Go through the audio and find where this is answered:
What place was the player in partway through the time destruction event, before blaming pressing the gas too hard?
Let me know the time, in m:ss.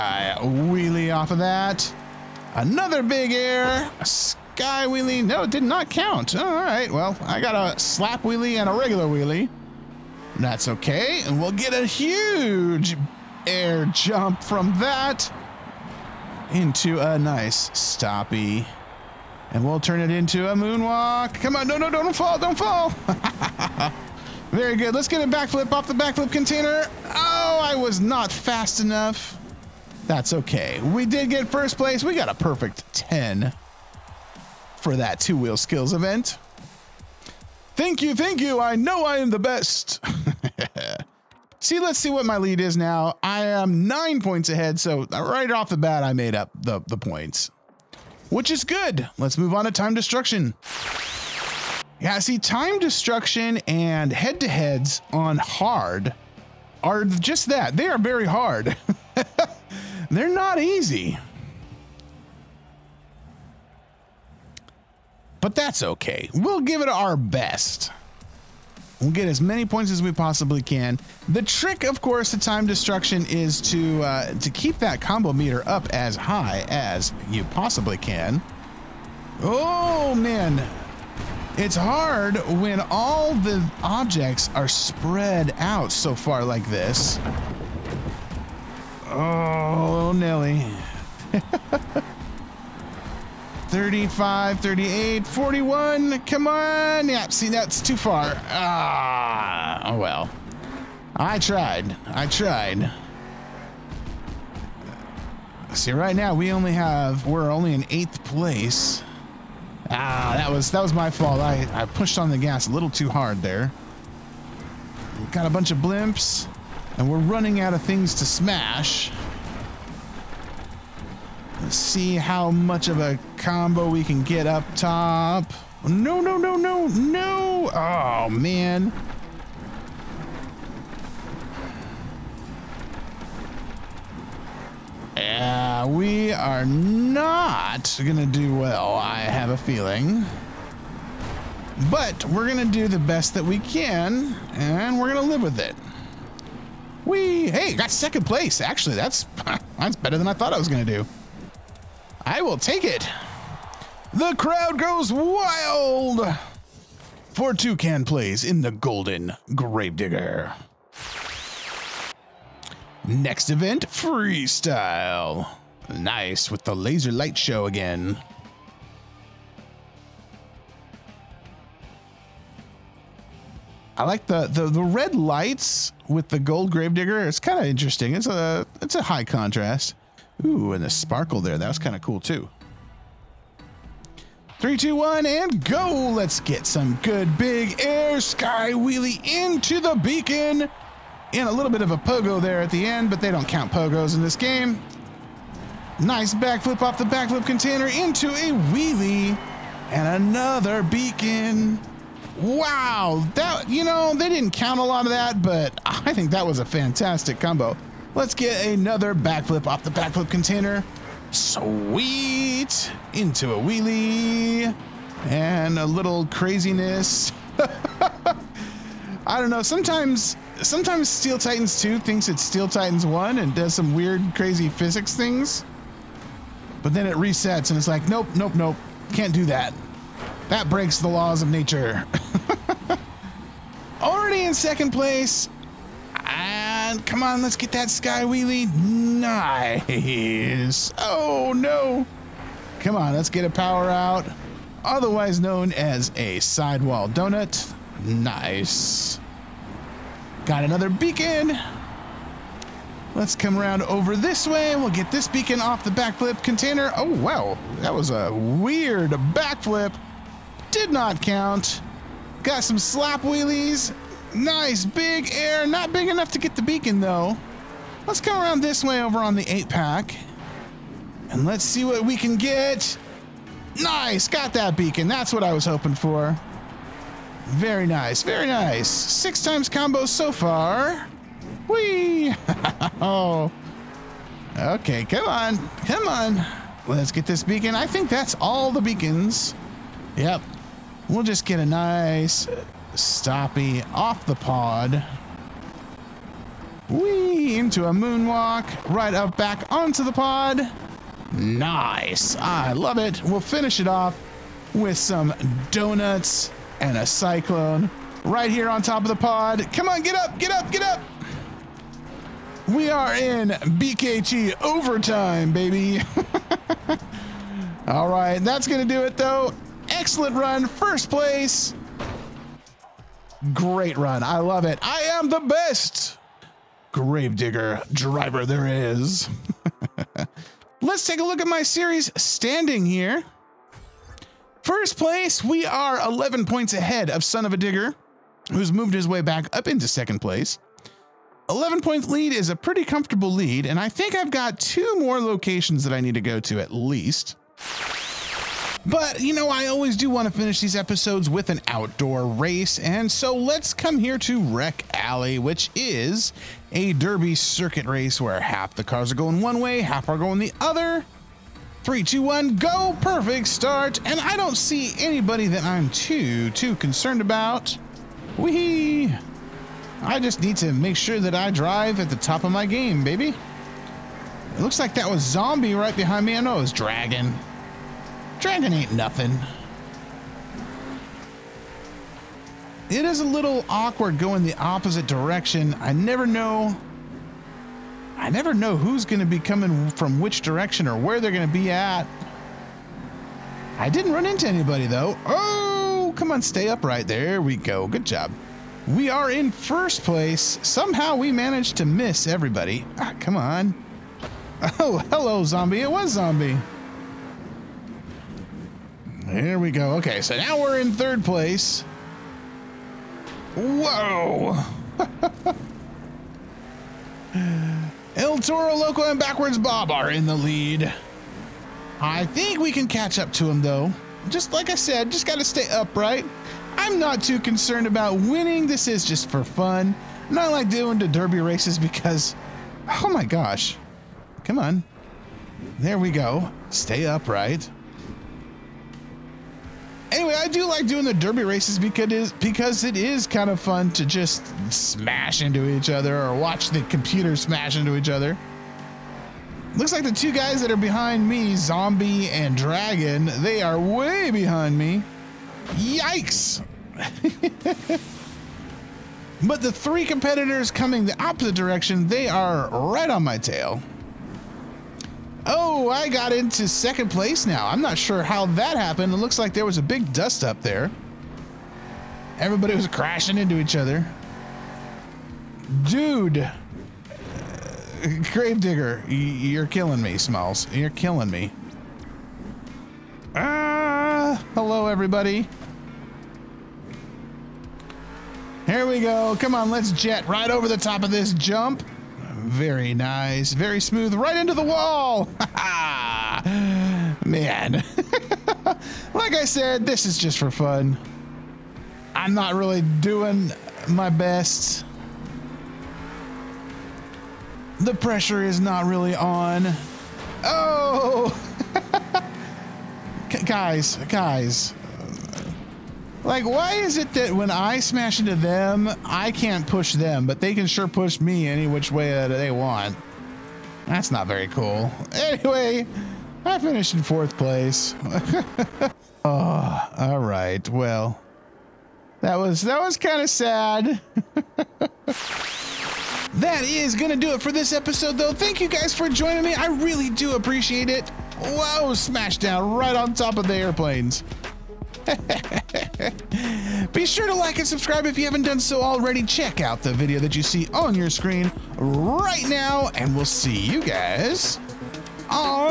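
1:47.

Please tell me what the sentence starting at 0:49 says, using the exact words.
Let's move on to time destruction.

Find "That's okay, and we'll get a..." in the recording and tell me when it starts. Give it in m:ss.
0:10.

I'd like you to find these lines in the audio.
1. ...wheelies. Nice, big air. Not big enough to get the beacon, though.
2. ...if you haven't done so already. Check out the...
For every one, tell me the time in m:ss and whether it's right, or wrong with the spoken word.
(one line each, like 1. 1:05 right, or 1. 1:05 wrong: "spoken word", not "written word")
1. 4:23 right
2. 9:08 right.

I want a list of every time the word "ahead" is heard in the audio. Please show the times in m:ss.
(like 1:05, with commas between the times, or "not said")
0:44, 5:36.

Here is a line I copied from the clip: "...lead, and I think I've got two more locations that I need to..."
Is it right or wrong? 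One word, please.
right.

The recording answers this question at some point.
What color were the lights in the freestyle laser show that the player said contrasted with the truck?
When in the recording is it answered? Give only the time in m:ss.
2:54.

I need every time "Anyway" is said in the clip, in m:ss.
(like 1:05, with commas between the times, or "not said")
7:20, 8:45.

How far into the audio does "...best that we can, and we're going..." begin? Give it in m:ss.
2:22.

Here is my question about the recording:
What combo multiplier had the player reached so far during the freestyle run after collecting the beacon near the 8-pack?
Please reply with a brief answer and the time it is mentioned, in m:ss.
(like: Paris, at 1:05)
6 times, at 4:38.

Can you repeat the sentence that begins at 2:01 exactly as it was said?
Let's see how much of a combo we can get up top.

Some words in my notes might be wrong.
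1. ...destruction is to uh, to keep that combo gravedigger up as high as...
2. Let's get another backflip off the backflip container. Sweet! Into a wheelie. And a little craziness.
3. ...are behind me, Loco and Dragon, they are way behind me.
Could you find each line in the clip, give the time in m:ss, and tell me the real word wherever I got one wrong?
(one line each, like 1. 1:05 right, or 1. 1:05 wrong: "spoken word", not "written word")
1. 1:12 wrong: "meter", not "gravedigger"
2. 3:28 right
3. 7:30 wrong: "Zombie", not "Loco".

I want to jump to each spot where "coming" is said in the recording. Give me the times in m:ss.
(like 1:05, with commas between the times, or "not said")
6:29, 7:40.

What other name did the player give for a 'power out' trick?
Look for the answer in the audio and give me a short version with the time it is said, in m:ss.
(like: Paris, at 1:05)
sidewall donut, at 4:06.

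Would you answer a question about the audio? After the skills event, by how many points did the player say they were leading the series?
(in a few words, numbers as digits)
9.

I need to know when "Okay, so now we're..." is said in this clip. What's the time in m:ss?
6:49.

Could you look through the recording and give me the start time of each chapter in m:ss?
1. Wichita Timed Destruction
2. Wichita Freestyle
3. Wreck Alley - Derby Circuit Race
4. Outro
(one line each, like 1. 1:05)
1. 0:50
2. 2:40
3. 5:47
4. 8:55.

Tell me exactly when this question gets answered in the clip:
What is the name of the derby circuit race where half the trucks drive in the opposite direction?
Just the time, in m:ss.
5:54.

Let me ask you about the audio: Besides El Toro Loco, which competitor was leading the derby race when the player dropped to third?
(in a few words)
Backwards Bob.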